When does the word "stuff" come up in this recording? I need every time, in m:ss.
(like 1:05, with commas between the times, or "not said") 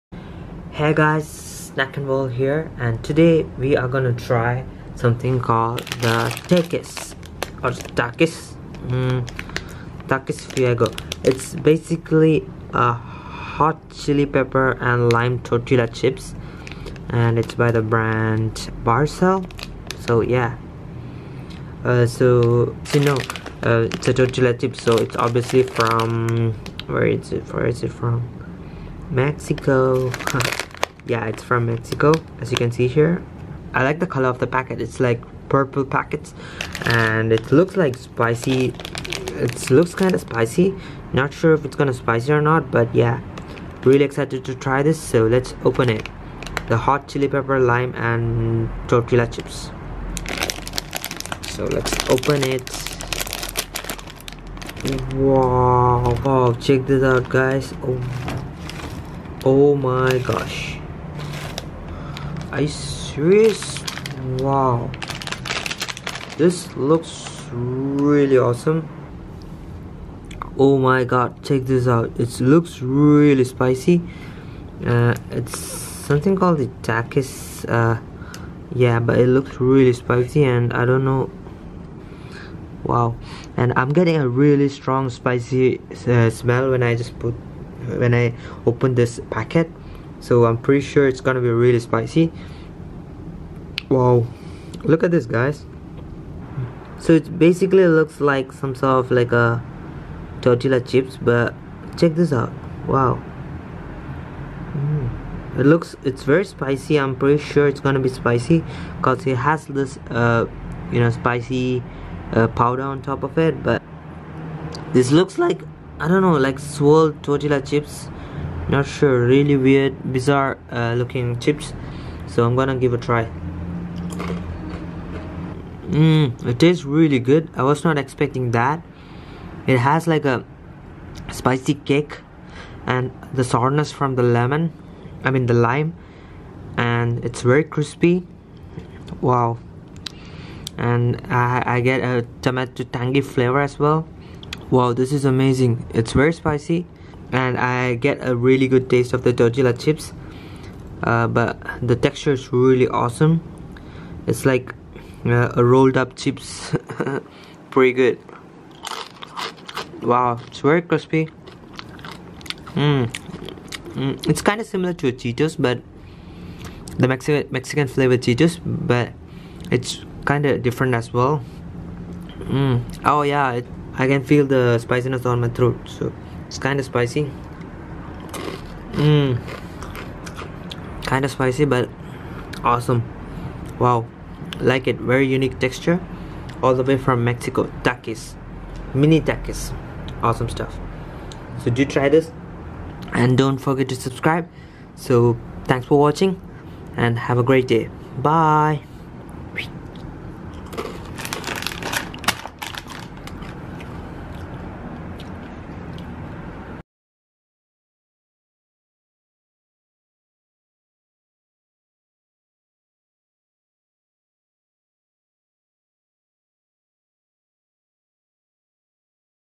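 3:10.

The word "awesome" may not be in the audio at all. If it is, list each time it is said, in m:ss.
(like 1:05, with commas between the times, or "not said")
1:08, 2:32, 3:02, 3:10.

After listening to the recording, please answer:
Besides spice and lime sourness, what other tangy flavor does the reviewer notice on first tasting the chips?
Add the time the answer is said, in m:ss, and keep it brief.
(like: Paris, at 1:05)
Tomato, at 2:22.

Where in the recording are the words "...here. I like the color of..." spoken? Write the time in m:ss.
0:32.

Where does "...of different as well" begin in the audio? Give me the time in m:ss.
2:50.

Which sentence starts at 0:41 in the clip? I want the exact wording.
Not sure if it's gonna spicy or not, but yeah.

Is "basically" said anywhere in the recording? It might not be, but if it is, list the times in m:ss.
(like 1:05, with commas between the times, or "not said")
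0:11, 1:37.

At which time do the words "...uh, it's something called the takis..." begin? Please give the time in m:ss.
1:14.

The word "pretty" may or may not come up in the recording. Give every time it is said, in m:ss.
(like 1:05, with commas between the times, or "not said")
1:30, 1:47, 2:37.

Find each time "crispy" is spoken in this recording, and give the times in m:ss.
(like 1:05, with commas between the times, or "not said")
2:17, 2:40.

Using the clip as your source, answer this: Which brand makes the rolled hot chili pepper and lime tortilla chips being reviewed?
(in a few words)
Barcel.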